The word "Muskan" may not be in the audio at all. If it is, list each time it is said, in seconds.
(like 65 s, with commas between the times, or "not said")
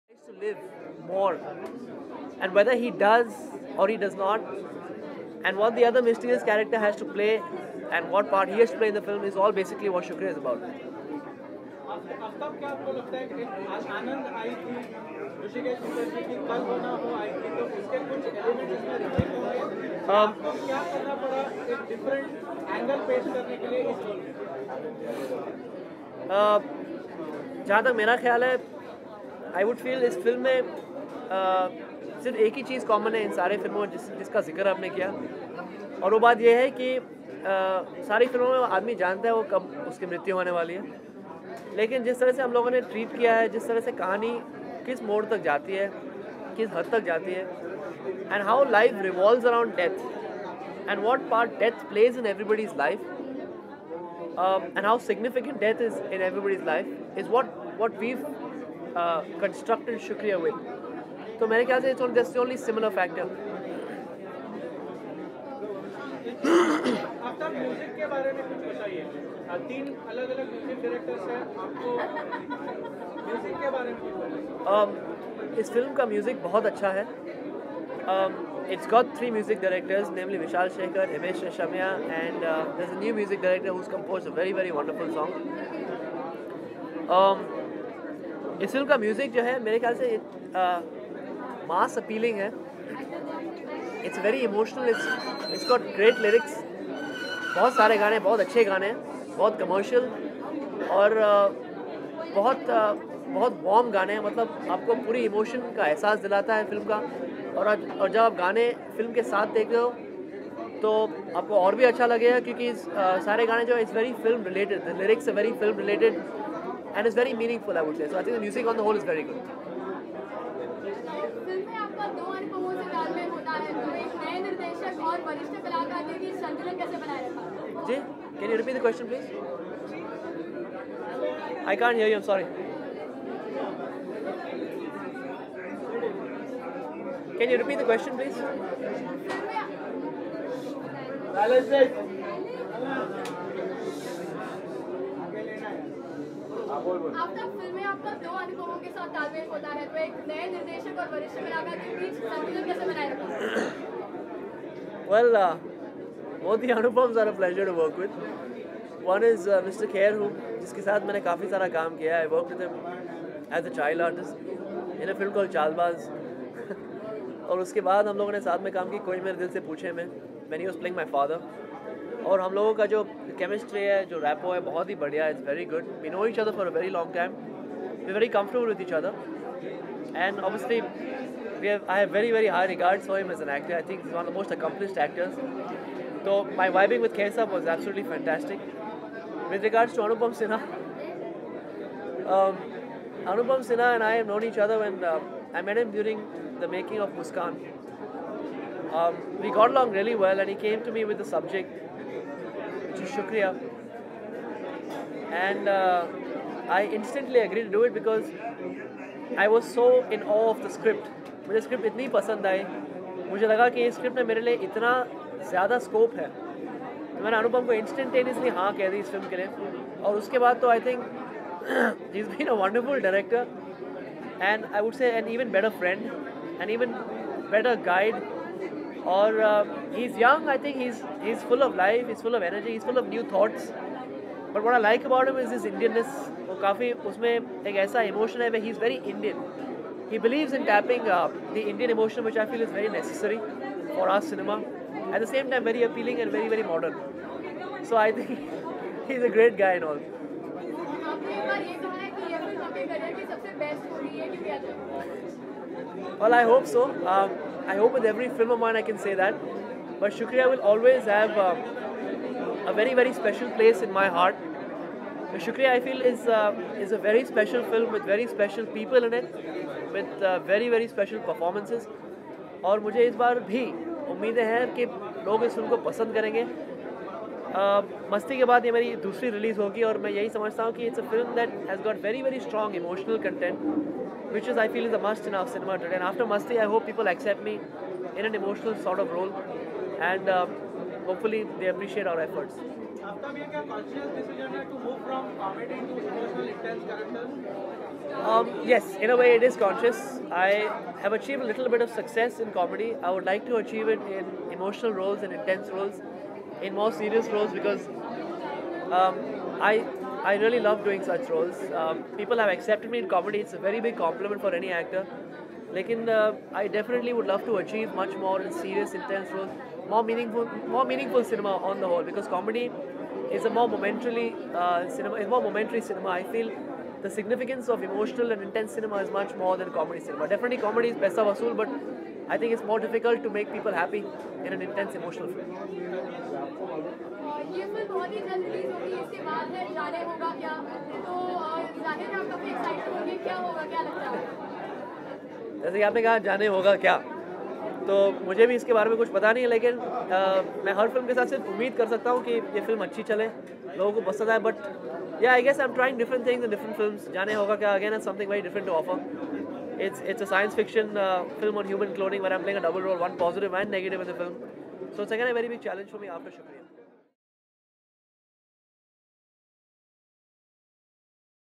197 s.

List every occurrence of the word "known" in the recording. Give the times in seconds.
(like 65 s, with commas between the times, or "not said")
194 s.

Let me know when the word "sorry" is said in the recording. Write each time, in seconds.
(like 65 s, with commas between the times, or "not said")
132 s.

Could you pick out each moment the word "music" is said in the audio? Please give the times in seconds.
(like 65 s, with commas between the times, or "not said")
83 s, 118 s.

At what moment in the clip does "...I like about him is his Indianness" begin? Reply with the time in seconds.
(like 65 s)
234 s.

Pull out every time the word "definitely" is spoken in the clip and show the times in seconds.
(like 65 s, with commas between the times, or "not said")
316 s, 330 s.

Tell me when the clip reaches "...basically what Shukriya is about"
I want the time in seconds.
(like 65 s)
9 s.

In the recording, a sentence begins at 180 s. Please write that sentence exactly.
And obviously, we have, I have very, very high regards for him as an actor.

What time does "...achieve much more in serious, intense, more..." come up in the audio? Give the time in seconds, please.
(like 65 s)
317 s.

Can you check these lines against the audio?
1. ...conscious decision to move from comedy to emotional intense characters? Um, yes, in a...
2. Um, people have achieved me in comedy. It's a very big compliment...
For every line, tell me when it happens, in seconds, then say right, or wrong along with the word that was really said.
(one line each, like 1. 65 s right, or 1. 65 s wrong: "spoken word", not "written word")
1. 293 s right
2. 311 s wrong: "accepted", not "achieved".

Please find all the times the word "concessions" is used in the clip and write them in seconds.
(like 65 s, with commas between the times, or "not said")
not said.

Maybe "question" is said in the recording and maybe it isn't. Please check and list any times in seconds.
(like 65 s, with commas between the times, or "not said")
128 s, 137 s.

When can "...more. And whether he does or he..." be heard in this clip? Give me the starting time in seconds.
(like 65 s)
1 s.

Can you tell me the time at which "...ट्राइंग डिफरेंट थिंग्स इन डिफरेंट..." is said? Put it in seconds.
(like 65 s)
355 s.